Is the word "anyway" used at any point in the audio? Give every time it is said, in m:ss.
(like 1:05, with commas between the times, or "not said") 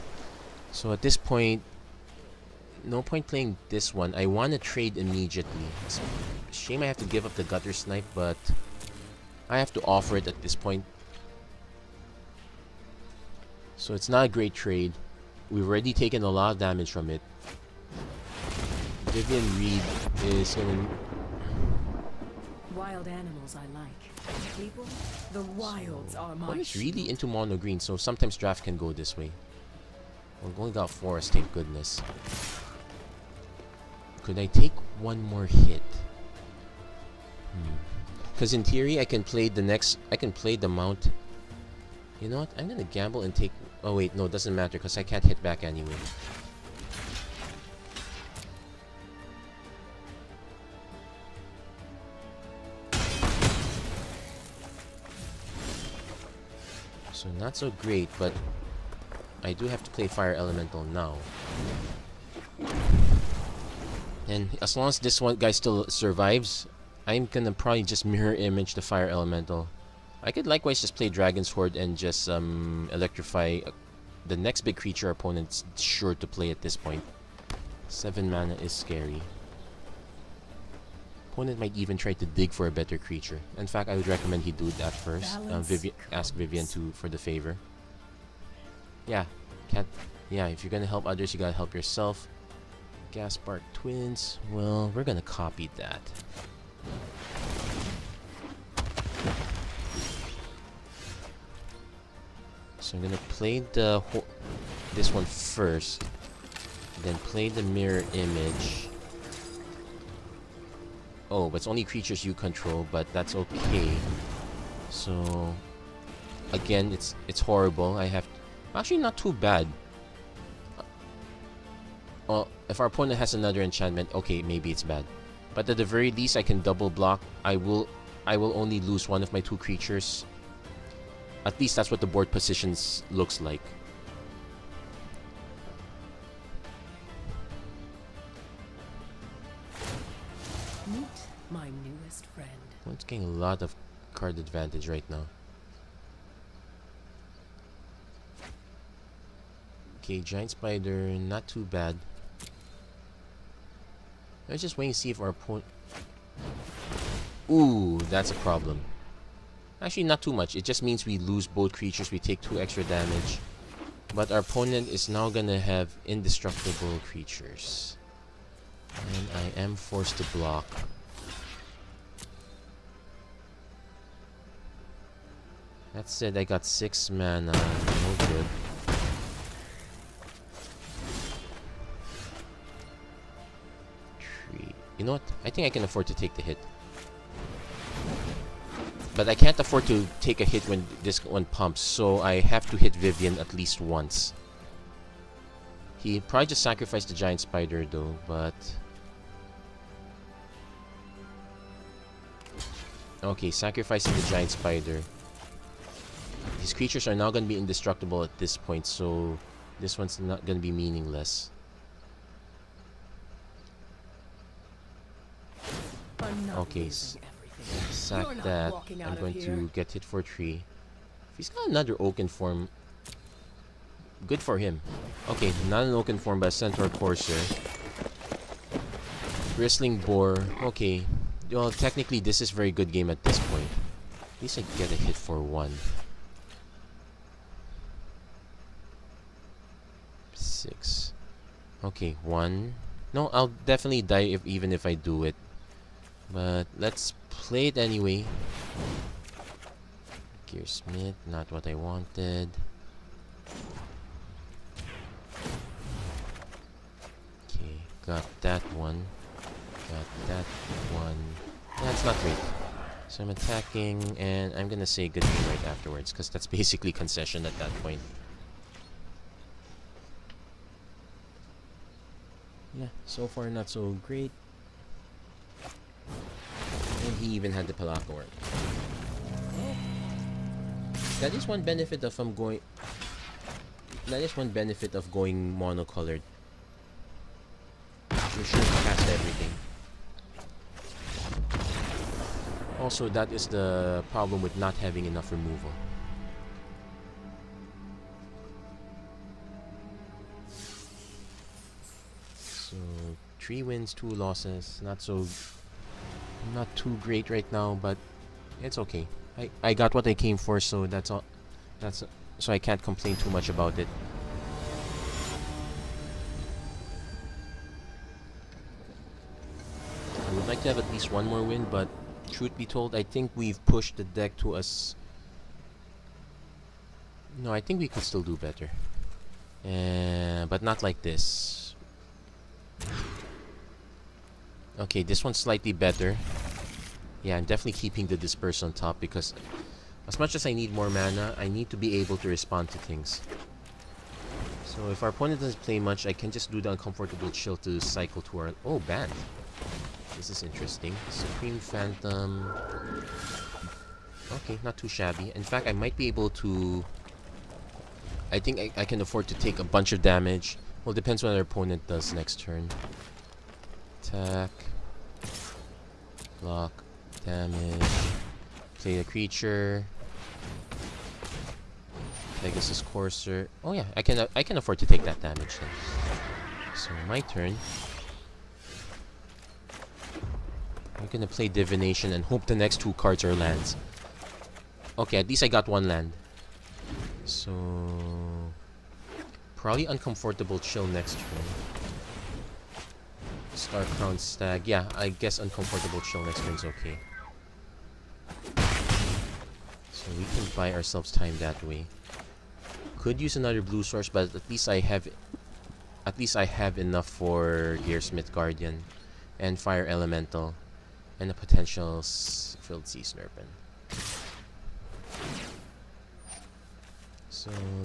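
0:45, 4:07.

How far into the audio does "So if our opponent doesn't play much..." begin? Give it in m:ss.
5:44.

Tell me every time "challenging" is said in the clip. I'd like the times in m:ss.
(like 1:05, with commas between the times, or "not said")
not said.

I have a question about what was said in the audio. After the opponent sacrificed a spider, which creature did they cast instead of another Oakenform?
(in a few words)
Centaur Courser.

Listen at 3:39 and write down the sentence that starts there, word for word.
I'm going to get hit for three.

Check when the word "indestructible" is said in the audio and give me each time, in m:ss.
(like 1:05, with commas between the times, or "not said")
2:46, 3:27.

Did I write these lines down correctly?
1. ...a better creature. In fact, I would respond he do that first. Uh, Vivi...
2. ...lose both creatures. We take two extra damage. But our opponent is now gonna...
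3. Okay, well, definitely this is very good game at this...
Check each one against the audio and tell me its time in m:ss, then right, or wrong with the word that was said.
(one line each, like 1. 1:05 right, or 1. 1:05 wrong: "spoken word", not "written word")
1. 1:22 wrong: "recommend", not "respond"
2. 2:41 right
3. 3:50 wrong: "technically", not "definitely".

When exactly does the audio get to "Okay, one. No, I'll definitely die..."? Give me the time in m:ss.
4:01.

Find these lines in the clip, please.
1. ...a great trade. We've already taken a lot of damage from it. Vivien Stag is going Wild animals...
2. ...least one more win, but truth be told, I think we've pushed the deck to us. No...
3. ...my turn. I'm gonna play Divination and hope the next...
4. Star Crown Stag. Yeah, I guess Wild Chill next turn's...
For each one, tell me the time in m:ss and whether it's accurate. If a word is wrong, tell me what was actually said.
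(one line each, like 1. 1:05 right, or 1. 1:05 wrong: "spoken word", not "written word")
1. 0:14 wrong: "Reid", not "Stag"
2. 5:20 right
3. 6:17 right
4. 6:33 wrong: "Uncomfortable", not "Wild".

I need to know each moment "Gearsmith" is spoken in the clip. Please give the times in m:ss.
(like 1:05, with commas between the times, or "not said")
4:10, 6:47.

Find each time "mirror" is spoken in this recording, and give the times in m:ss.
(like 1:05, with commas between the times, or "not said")
1:08, 1:47.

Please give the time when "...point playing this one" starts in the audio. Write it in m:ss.
0:03.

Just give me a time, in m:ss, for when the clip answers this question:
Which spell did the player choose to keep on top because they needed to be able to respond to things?
5:38.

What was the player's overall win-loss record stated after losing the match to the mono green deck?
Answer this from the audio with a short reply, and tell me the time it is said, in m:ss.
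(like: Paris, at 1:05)
3 wins, 2 losses, at 5:03.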